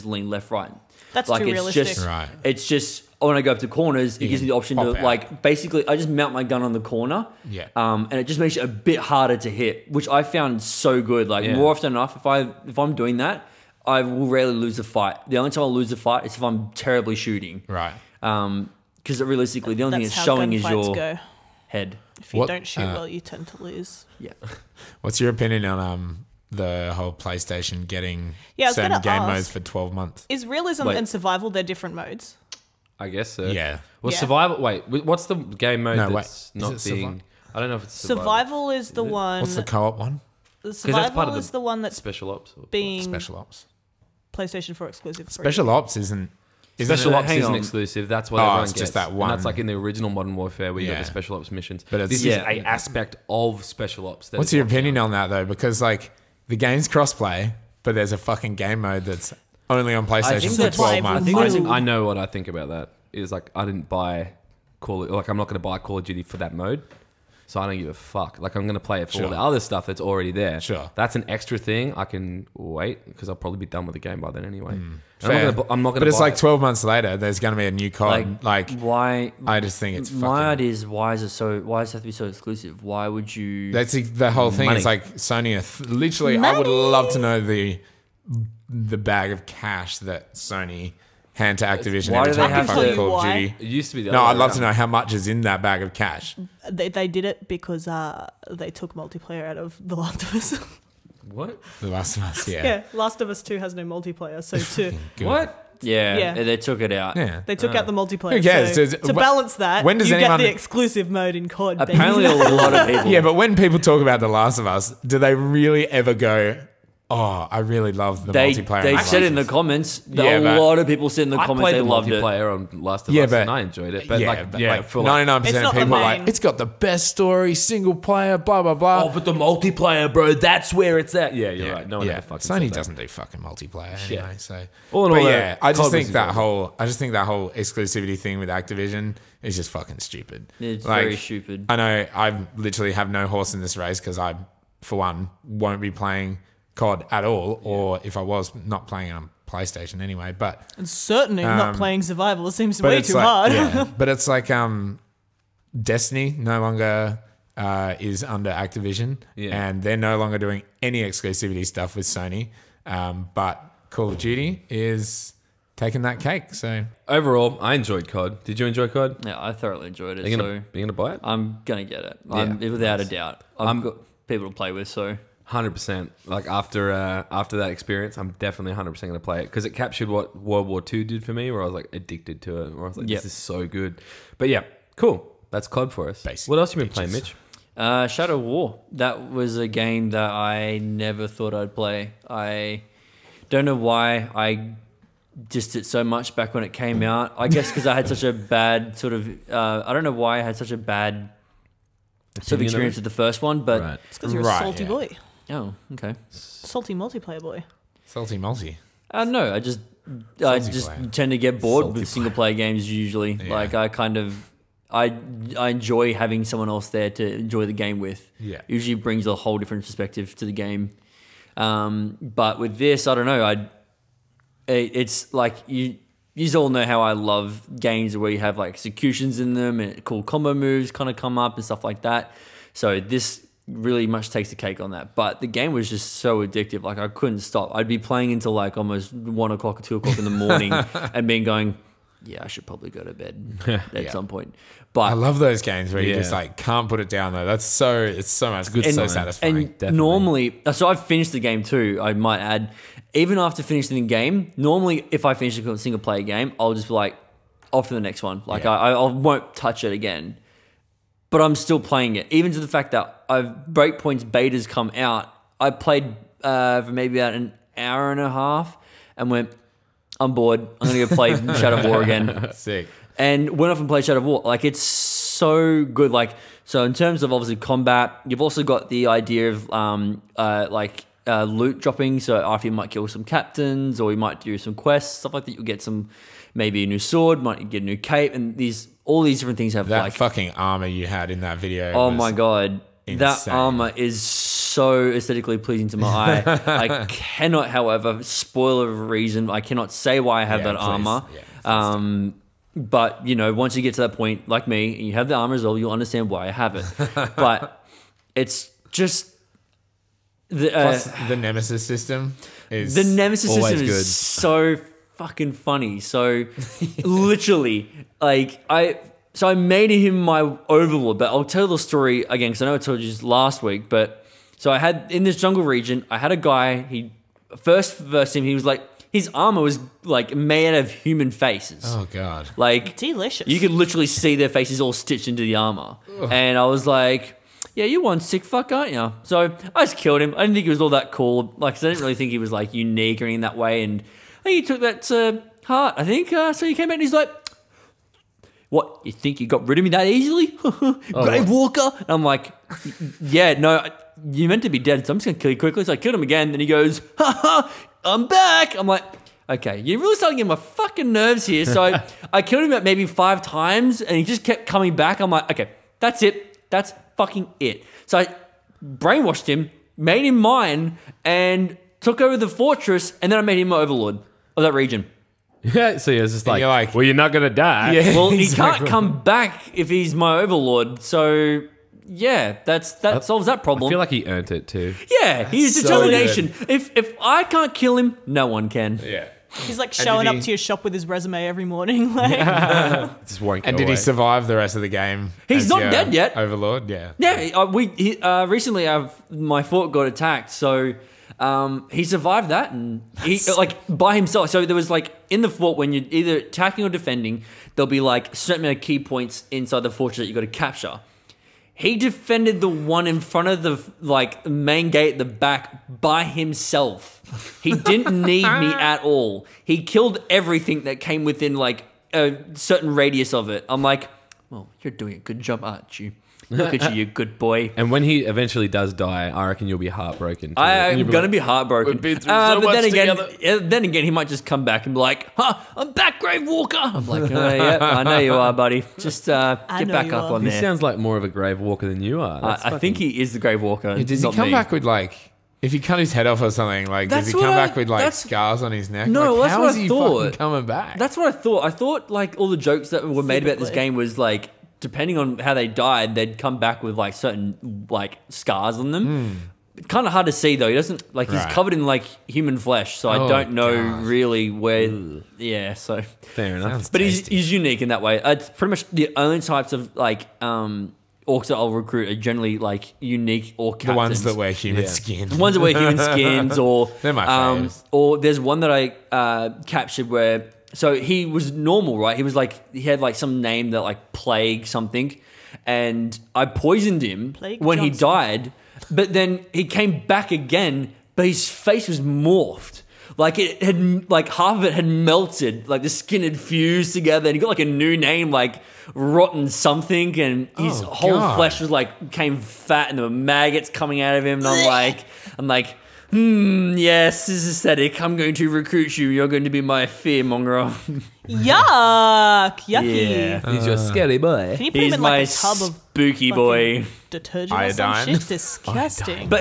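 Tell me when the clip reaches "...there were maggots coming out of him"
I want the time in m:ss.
8:22.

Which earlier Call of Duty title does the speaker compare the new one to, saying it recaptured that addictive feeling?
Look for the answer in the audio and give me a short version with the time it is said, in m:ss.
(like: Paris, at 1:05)
World War II, at 3:00.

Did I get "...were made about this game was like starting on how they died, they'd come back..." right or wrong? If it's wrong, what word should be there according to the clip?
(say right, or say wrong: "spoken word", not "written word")
wrong: "depending", not "starting".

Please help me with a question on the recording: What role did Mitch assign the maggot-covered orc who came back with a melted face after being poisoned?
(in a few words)
Fearmonger.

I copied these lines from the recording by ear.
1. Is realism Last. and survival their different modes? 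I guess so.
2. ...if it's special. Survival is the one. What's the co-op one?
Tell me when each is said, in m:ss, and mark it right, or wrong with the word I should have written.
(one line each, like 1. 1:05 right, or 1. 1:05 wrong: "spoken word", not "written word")
1. 0:30 wrong: "Wait", not "Last"
2. 0:37 wrong: "survival", not "special".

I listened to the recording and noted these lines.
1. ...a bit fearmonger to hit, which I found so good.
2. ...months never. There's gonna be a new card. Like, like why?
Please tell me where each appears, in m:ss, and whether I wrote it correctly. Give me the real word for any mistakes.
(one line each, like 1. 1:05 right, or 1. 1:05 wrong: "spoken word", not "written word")
1. 0:08 wrong: "harder", not "fearmonger"
2. 1:16 wrong: "later", not "never".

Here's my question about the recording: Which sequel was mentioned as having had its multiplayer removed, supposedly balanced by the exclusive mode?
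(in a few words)
The Last of Us 2.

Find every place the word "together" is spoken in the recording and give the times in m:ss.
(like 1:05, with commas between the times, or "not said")
7:13, 8:16.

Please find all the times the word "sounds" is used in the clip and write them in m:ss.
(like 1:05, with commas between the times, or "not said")
7:20, 7:46.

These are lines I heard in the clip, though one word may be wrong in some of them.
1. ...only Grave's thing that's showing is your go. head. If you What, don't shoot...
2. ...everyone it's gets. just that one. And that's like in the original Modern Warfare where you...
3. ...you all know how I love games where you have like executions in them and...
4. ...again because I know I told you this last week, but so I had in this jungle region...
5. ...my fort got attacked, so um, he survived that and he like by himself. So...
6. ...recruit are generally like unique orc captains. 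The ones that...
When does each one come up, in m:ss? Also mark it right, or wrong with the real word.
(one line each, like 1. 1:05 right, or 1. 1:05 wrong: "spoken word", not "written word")
1. 0:19 wrong: "That", not "Grave"
2. 0:48 right
3. 3:46 right
4. 5:22 right
5. 6:39 right
6. 7:51 right.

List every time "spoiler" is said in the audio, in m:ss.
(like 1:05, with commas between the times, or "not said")
4:58.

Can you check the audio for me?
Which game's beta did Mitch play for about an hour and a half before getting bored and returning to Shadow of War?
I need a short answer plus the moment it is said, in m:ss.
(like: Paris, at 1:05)
Breakpoint, at 4:23.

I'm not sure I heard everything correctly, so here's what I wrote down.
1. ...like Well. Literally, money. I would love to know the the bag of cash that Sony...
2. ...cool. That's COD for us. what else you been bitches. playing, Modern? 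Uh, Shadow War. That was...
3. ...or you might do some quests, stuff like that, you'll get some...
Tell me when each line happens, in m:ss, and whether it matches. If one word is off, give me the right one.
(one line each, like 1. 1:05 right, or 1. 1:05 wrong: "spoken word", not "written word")
1. 1:24 wrong: "Sony", not "Well"
2. 3:04 wrong: "Mitch", not "Modern"
3. 4:44 right.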